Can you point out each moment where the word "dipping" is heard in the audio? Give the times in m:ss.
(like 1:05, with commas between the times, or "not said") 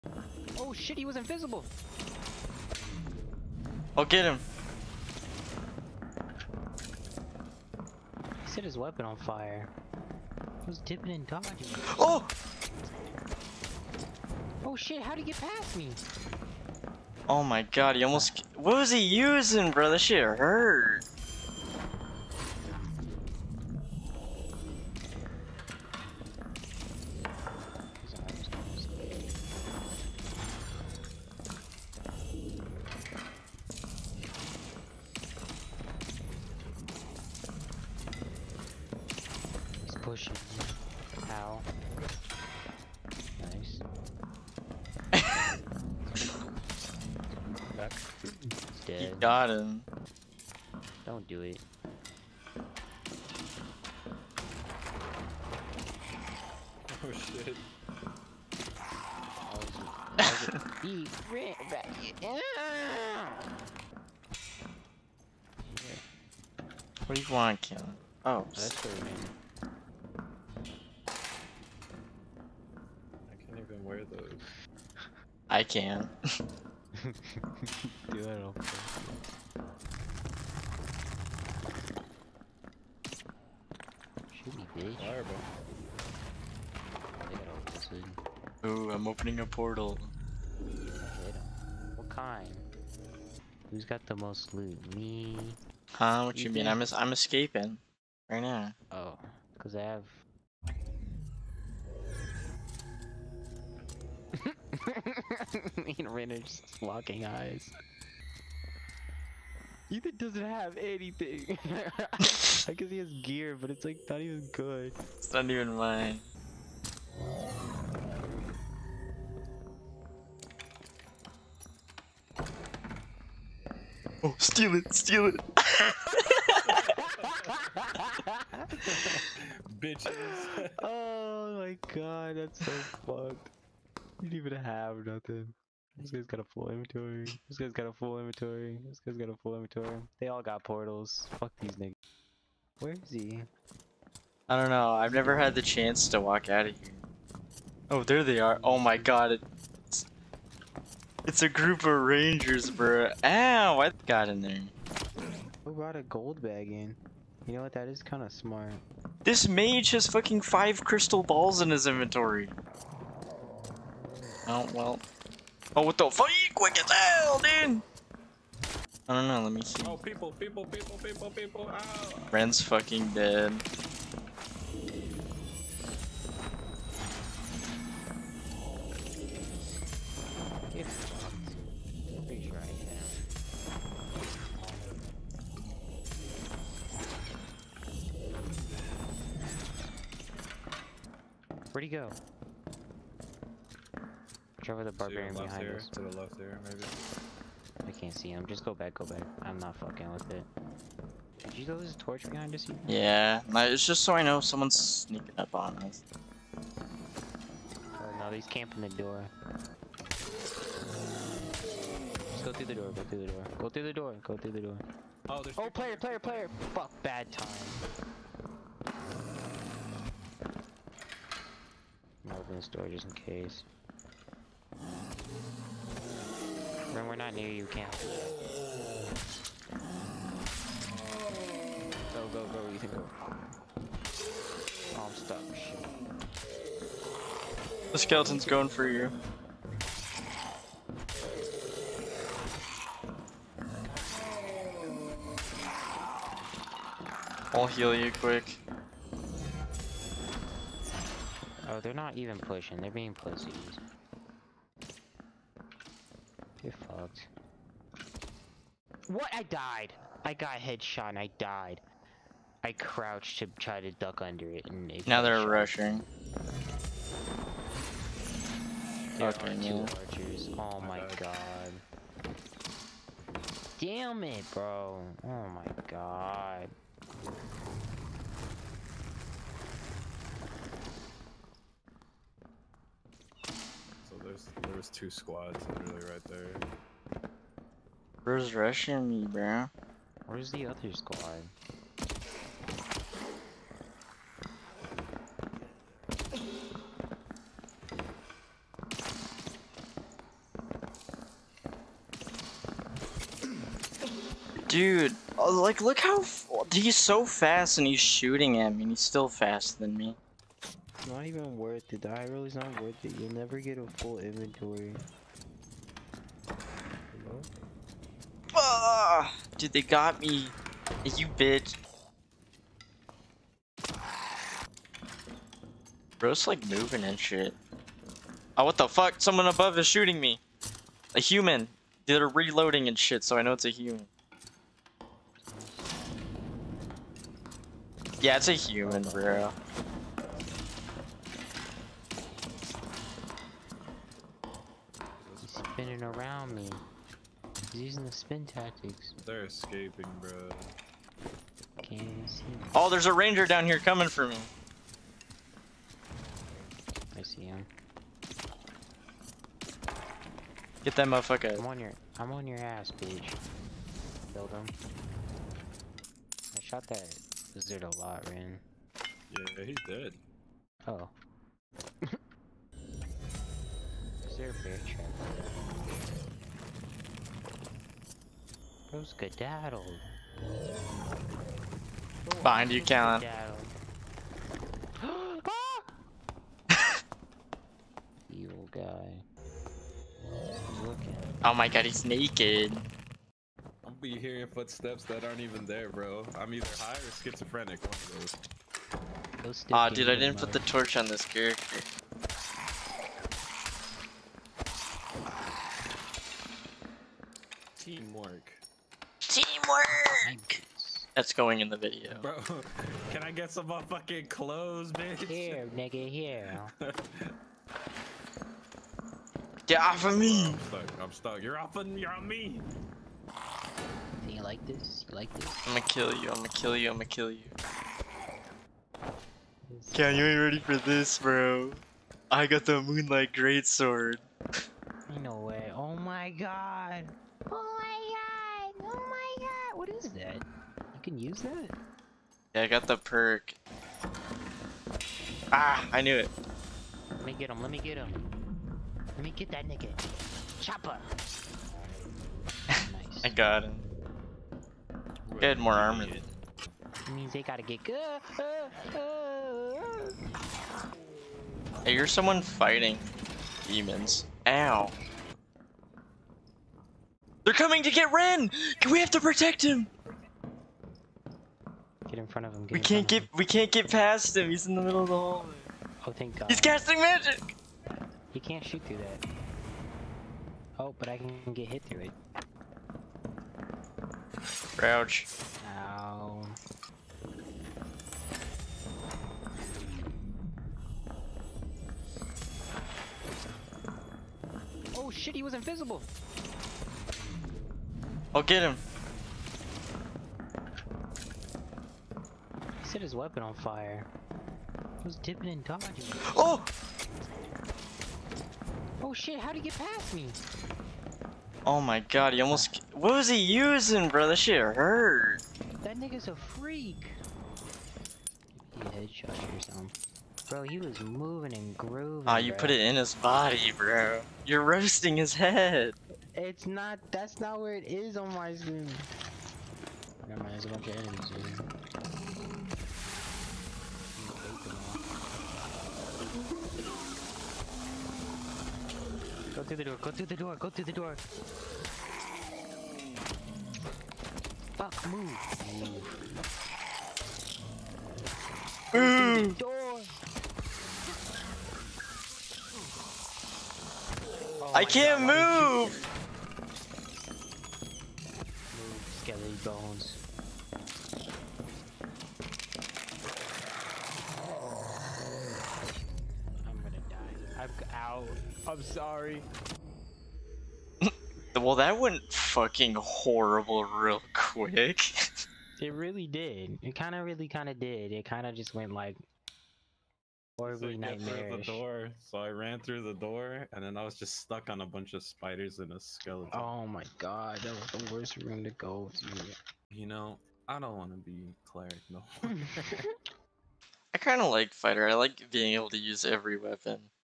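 0:10, 8:25.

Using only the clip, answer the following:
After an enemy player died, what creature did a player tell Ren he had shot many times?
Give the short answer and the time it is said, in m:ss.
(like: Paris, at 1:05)
lizard, at 6:07.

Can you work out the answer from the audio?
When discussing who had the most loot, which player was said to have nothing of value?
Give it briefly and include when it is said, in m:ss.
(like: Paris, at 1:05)
Ethan, at 1:49.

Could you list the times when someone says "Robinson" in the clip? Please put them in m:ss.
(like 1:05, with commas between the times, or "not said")
not said.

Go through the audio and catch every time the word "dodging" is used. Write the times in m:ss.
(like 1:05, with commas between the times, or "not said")
0:11, 8:25.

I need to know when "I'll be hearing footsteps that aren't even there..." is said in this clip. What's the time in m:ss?
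6:33.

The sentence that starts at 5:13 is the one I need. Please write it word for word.
You'll never get a full inventory.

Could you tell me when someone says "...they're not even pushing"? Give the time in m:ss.
4:11.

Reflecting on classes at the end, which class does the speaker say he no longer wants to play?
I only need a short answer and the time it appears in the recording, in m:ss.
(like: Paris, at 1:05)
cleric, at 9:51.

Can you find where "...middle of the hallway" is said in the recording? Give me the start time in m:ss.
7:54.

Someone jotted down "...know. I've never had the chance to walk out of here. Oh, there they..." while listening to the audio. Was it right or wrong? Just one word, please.
right.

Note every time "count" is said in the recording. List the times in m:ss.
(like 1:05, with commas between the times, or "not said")
not said.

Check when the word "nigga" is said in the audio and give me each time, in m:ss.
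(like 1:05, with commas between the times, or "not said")
2:21, 6:55, 7:29, 8:35.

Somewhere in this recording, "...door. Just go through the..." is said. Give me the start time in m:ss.
3:28.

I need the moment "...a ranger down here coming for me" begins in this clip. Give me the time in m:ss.
5:53.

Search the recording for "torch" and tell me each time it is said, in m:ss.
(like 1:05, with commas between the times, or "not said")
3:21, 6:40.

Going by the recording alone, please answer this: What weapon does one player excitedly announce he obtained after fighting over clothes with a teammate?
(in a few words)
Moonlight Greatsword.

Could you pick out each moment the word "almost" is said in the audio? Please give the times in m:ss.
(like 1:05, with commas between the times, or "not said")
0:18, 8:32.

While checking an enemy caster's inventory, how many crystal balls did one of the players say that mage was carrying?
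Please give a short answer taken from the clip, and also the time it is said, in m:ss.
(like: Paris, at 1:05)
5, at 2:40.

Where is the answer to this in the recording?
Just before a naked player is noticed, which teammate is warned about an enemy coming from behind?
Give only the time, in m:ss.
6:22.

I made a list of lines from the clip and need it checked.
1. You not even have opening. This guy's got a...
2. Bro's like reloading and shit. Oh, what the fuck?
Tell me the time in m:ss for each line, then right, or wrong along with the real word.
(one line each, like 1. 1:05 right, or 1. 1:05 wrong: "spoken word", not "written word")
1. 2:14 wrong: "nothing", not "opening"
2. 5:26 wrong: "moving", not "reloading".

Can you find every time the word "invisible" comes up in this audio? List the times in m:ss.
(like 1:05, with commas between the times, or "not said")
0:01, 8:15.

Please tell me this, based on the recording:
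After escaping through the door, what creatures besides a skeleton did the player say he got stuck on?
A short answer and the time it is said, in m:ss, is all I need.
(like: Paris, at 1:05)
spiders, at 9:45.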